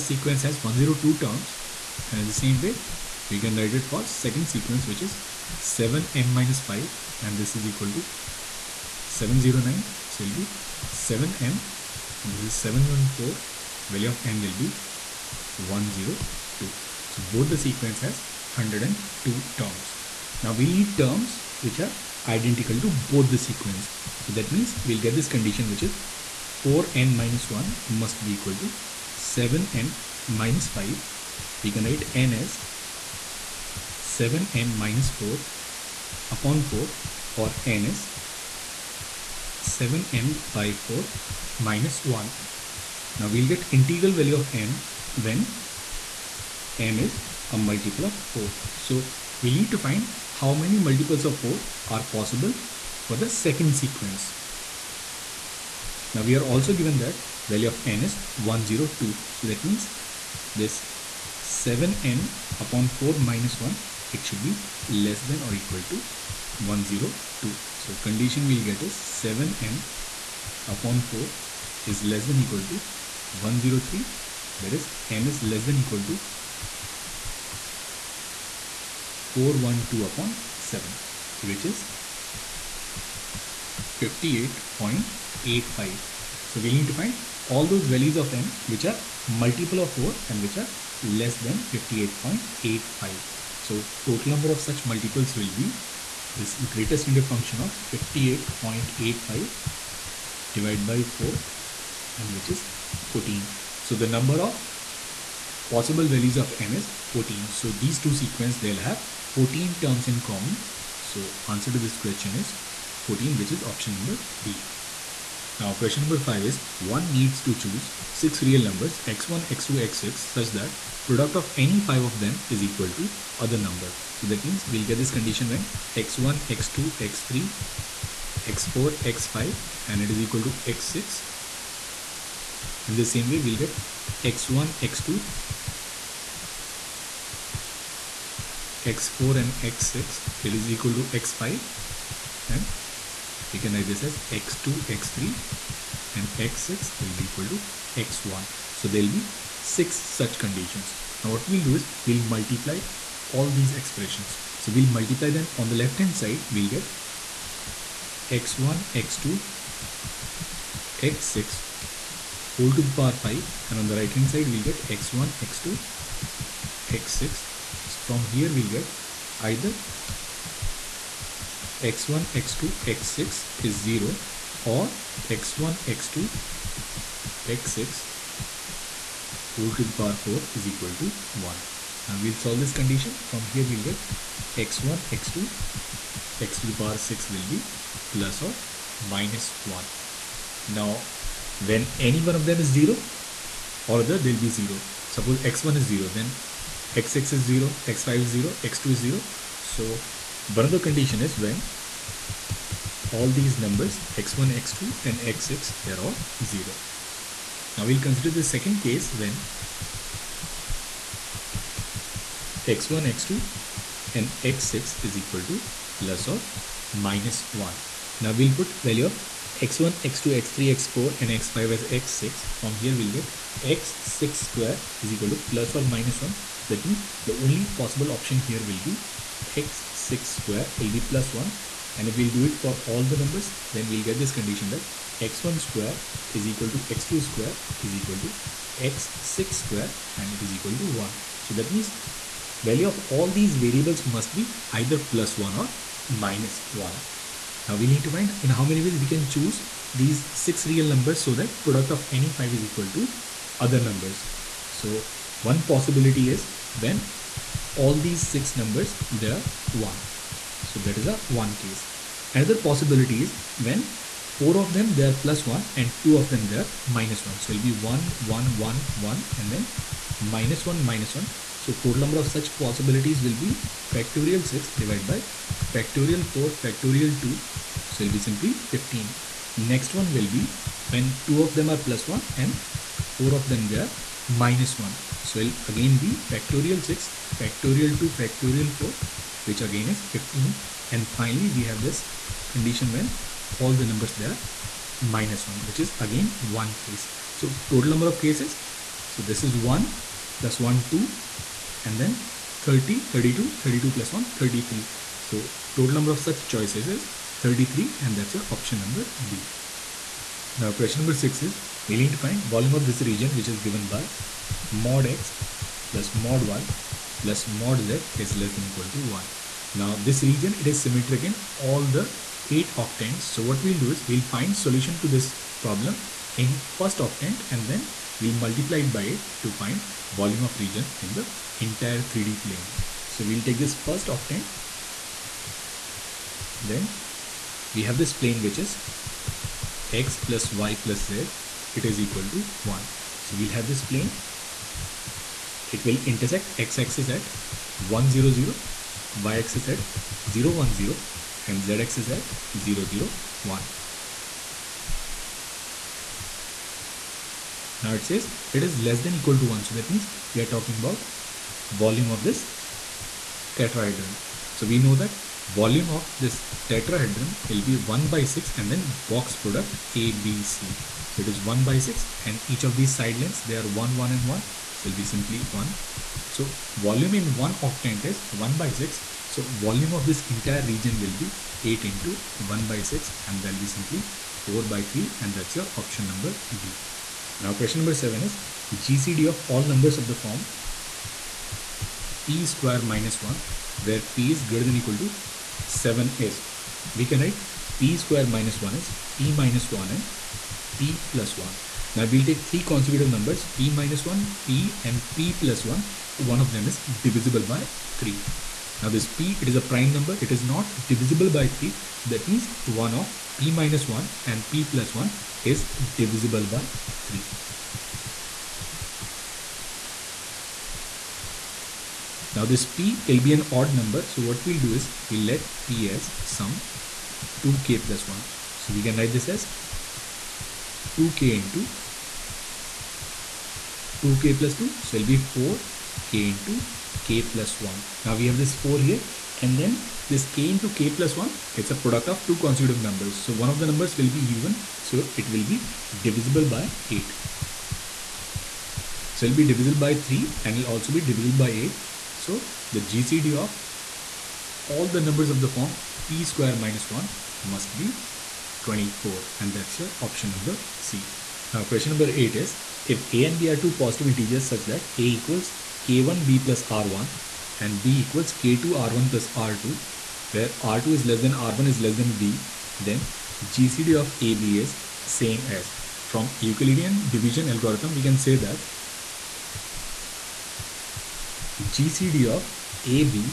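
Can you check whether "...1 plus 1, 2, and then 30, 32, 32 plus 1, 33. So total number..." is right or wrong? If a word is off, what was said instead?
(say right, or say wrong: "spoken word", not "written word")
right.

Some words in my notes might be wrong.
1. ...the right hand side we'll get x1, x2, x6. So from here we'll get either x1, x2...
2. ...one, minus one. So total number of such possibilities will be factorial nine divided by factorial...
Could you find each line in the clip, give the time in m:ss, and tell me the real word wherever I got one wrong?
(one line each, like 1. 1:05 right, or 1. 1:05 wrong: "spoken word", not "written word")
1. 2:43 right
2. 4:30 wrong: "six", not "nine".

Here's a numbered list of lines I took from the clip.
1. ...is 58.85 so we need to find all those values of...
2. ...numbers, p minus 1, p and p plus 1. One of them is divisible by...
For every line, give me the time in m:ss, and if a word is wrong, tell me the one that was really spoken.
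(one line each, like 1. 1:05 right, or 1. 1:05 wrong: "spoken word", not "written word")
1. 1:21 right
2. 6:43 right.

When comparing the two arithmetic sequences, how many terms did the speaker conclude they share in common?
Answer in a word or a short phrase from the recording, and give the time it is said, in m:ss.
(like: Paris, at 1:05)
14, at 1:49.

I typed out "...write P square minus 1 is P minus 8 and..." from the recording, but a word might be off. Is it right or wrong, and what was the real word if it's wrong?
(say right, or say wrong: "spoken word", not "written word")
wrong: "1", not "8".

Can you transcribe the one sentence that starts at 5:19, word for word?
Now this region, it is symmetric in all the 8 octants.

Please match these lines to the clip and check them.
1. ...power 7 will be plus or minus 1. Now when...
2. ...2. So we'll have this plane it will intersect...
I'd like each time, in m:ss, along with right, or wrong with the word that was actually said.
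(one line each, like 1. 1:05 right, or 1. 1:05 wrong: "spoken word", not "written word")
1. 3:06 wrong: "6", not "7"
2. 5:42 wrong: "1", not "2".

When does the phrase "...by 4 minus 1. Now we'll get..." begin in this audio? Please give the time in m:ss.
0:40.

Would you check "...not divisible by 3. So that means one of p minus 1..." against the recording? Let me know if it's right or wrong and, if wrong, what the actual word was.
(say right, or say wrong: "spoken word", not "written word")
right.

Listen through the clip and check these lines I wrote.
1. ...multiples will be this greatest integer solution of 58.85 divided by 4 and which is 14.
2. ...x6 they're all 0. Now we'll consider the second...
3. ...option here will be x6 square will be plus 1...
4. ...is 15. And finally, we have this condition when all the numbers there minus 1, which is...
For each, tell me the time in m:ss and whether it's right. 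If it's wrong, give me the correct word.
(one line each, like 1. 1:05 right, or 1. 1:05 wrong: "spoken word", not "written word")
1. 1:34 wrong: "function", not "solution"
2. 3:25 right
3. 3:48 right
4. 4:49 right.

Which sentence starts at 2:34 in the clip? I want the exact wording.
So we'll multiply them on the left hand side.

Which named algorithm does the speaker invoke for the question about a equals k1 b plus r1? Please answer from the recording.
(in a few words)
Euclidean division algorithm.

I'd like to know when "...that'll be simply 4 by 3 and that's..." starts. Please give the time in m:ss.
6:23.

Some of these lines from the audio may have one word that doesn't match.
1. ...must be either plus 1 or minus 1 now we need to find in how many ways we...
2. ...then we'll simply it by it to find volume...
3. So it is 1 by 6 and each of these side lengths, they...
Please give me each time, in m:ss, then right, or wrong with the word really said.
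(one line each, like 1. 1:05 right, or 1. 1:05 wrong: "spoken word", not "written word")
1. 4:04 right
2. 5:27 wrong: "multiply", not "simply"
3. 6:11 right.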